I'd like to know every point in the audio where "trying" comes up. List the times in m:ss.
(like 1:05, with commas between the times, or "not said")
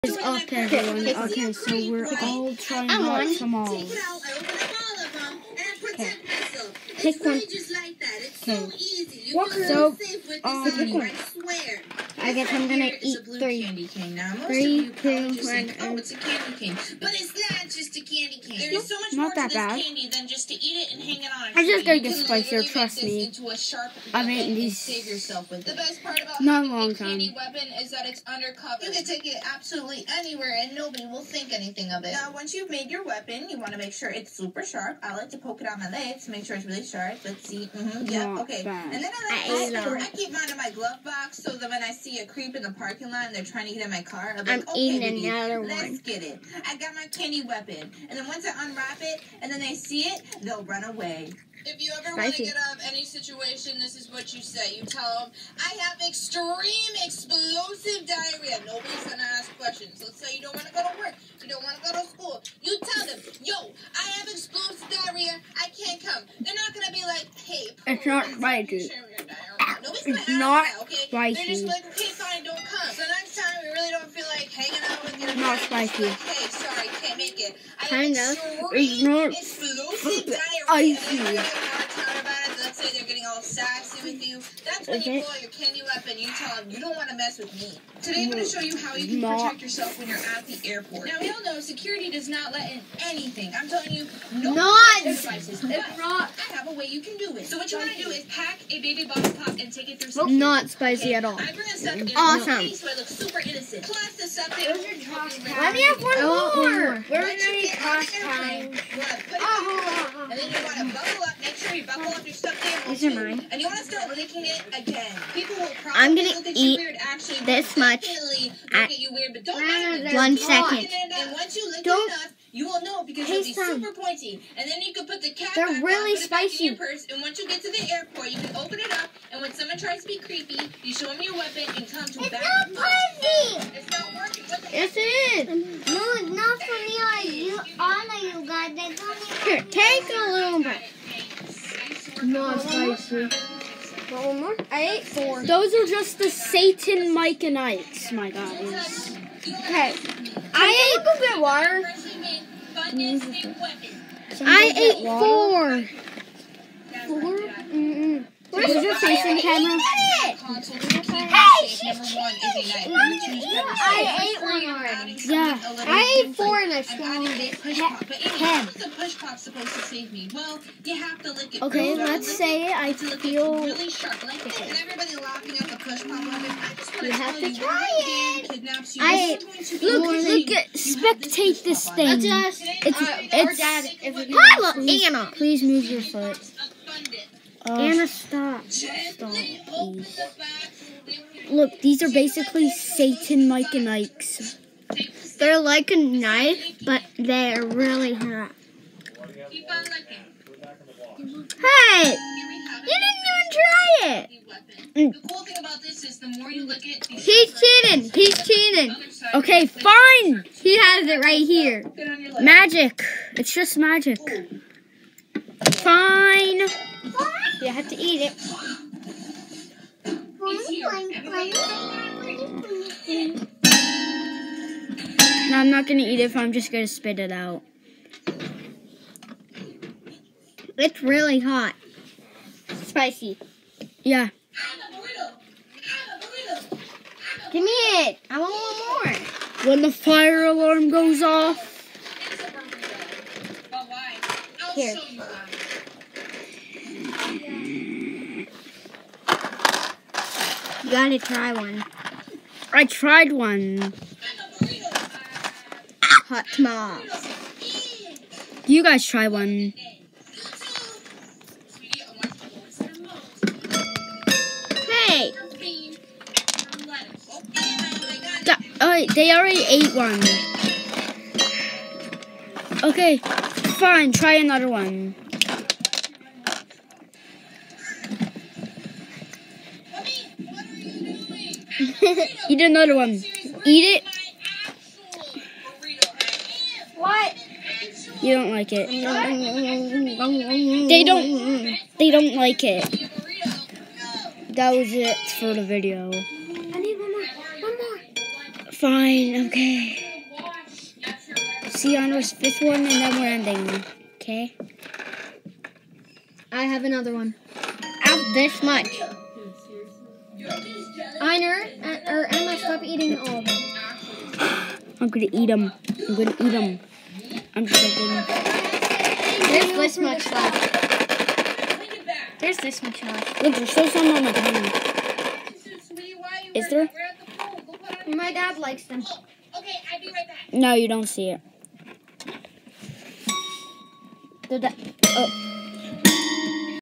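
0:02, 0:43.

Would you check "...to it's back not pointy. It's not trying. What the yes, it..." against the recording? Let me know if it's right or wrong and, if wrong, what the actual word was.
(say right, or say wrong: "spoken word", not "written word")
wrong: "working", not "trying".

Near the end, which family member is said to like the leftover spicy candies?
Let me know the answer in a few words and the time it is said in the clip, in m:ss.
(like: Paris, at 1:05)
dad, at 5:28.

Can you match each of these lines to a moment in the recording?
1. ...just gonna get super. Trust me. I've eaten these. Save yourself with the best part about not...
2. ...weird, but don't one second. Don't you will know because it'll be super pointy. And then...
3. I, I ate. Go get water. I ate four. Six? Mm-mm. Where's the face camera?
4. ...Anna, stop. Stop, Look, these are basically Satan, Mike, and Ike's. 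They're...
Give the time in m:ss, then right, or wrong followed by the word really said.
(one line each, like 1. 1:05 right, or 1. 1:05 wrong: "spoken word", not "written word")
1. 0:21 wrong: "spicier", not "super"
2. 1:59 right
3. 2:29 wrong: "Four", not "Six"
4. 3:07 right.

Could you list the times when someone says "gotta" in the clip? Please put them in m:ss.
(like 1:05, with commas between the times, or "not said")
4:10.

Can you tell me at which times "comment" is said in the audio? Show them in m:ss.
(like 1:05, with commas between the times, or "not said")
not said.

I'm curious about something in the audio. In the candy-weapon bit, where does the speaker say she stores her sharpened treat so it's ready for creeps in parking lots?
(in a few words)
glove box.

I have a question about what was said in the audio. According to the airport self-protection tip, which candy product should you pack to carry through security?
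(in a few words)
Baby Bottle Pop.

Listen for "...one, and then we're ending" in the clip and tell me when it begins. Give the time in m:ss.
5:02.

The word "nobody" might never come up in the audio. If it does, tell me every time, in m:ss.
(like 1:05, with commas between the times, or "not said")
0:30, 0:58.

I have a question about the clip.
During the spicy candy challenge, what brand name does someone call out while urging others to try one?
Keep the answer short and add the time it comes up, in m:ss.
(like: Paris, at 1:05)
Hot Tamales, at 4:16.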